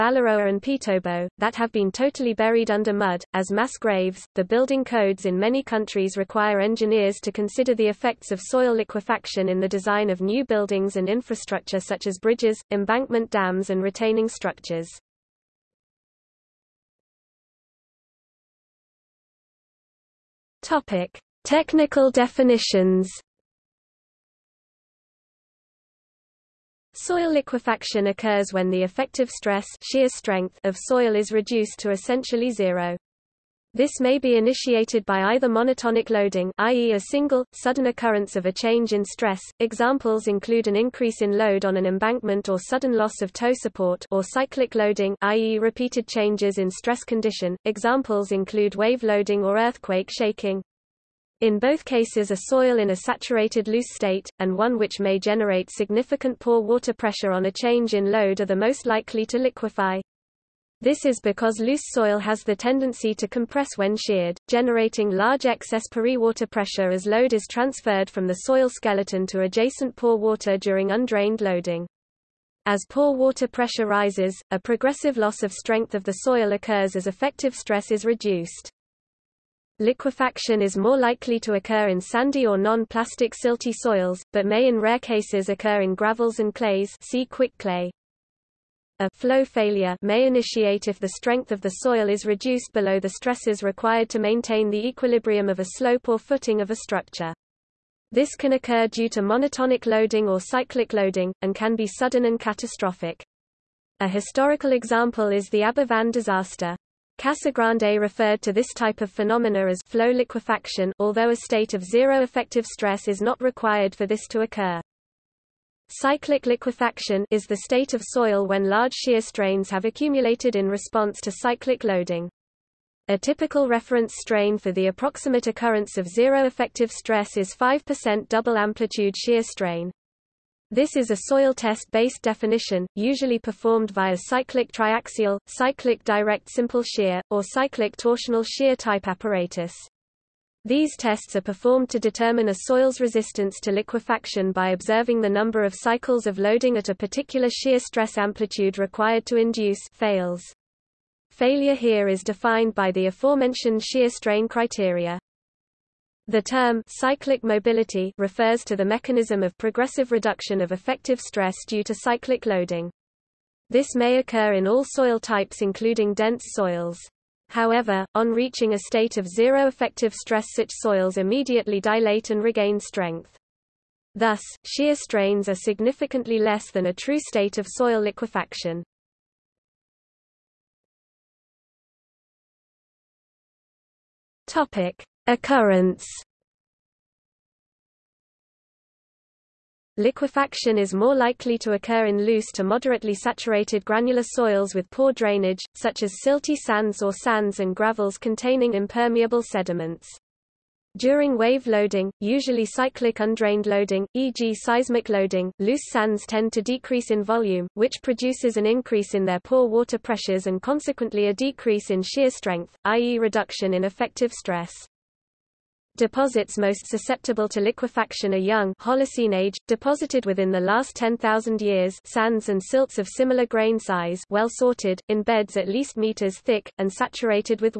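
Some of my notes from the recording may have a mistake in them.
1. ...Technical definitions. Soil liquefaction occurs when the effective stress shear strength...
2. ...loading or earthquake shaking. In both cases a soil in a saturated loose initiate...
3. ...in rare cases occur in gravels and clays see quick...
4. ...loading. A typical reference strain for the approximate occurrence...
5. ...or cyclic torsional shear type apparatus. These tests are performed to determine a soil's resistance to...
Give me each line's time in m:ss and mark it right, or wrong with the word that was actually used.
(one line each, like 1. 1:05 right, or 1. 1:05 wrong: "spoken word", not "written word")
1. 0:21 right
2. 0:49 wrong: "state", not "initiate"
3. 1:24 right
4. 2:01 right
5. 2:17 right.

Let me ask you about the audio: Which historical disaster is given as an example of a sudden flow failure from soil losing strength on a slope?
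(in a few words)
Aberfan disaster.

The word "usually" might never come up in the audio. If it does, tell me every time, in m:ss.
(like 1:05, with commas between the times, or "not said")
2:12, 3:22.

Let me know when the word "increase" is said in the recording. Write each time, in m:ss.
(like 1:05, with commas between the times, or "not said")
0:40, 3:28.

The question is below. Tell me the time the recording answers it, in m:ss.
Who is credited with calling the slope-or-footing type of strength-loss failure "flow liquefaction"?
1:47.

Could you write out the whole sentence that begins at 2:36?
The term cyclic mobility refers to the mechanism of progressive reduction of effective stress due to cyclic loading.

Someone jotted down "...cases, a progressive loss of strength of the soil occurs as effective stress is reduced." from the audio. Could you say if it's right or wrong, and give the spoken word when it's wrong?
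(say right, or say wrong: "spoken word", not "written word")
wrong: "rises", not "cases".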